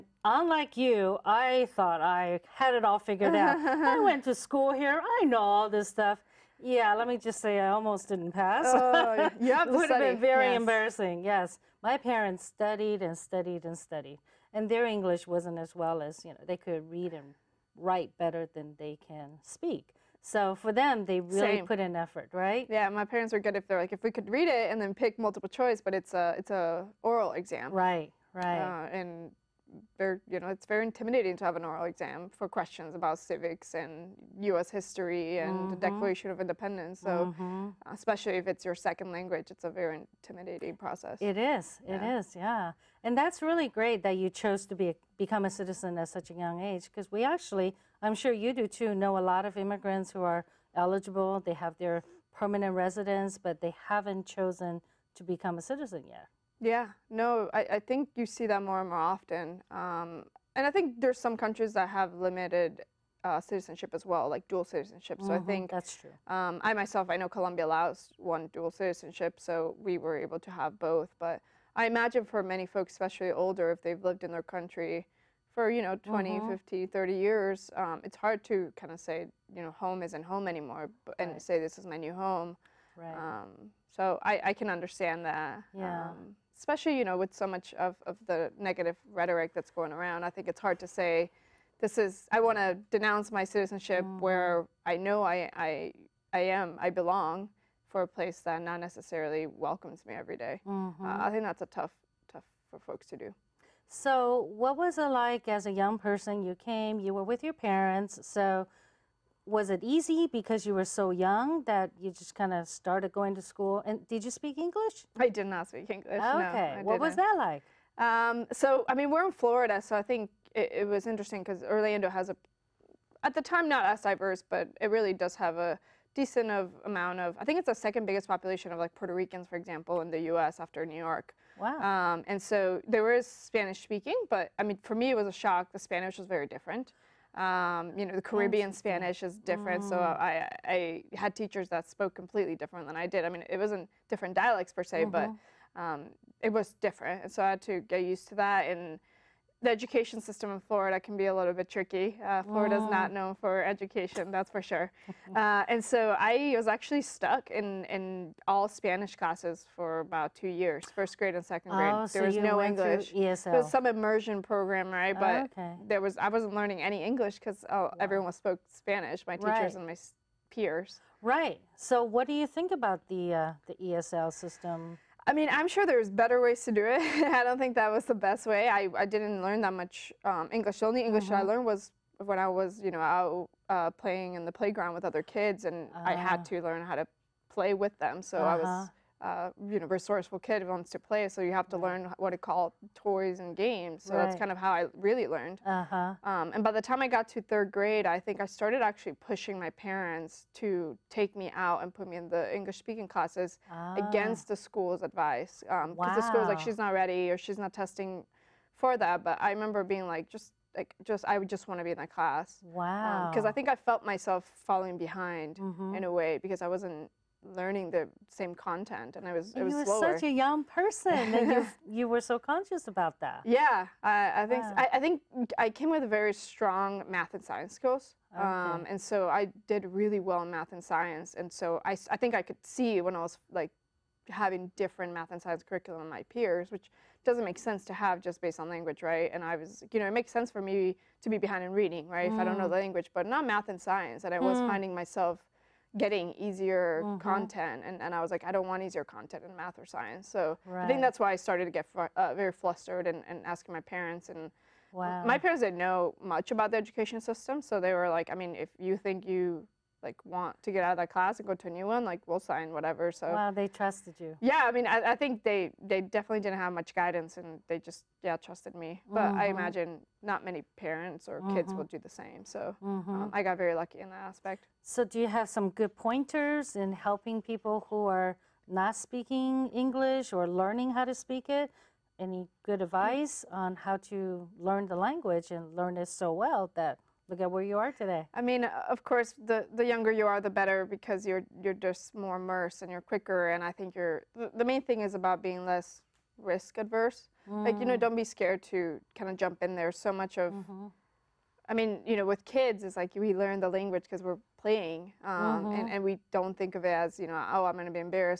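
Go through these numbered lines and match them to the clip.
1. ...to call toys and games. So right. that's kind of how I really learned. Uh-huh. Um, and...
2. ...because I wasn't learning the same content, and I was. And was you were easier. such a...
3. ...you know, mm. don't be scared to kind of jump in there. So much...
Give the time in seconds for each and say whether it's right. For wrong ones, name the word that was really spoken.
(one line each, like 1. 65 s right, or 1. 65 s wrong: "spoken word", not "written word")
1. 192 s right
2. 216 s wrong: "slower", not "easier"
3. 297 s right.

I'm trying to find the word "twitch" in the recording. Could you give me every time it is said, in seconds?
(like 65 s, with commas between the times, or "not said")
not said.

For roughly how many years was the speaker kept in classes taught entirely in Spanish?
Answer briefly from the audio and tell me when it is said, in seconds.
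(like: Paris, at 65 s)
2, at 160 s.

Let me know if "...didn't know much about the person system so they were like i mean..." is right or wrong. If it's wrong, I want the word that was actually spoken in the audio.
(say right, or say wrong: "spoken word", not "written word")
wrong: "education", not "person".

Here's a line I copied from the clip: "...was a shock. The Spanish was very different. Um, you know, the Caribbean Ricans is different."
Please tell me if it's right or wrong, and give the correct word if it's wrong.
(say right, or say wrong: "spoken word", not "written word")
wrong: "Spanish", not "Ricans".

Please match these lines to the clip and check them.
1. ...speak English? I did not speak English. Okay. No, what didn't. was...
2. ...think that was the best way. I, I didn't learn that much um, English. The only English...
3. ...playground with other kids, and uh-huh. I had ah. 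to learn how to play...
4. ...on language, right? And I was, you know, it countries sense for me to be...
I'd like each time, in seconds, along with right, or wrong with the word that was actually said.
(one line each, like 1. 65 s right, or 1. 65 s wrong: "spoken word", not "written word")
1. 114 s right
2. 177 s right
3. 184 s right
4. 238 s wrong: "makes", not "countries".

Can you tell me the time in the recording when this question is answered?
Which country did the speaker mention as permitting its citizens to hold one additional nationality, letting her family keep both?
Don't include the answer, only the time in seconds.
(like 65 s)
67 s.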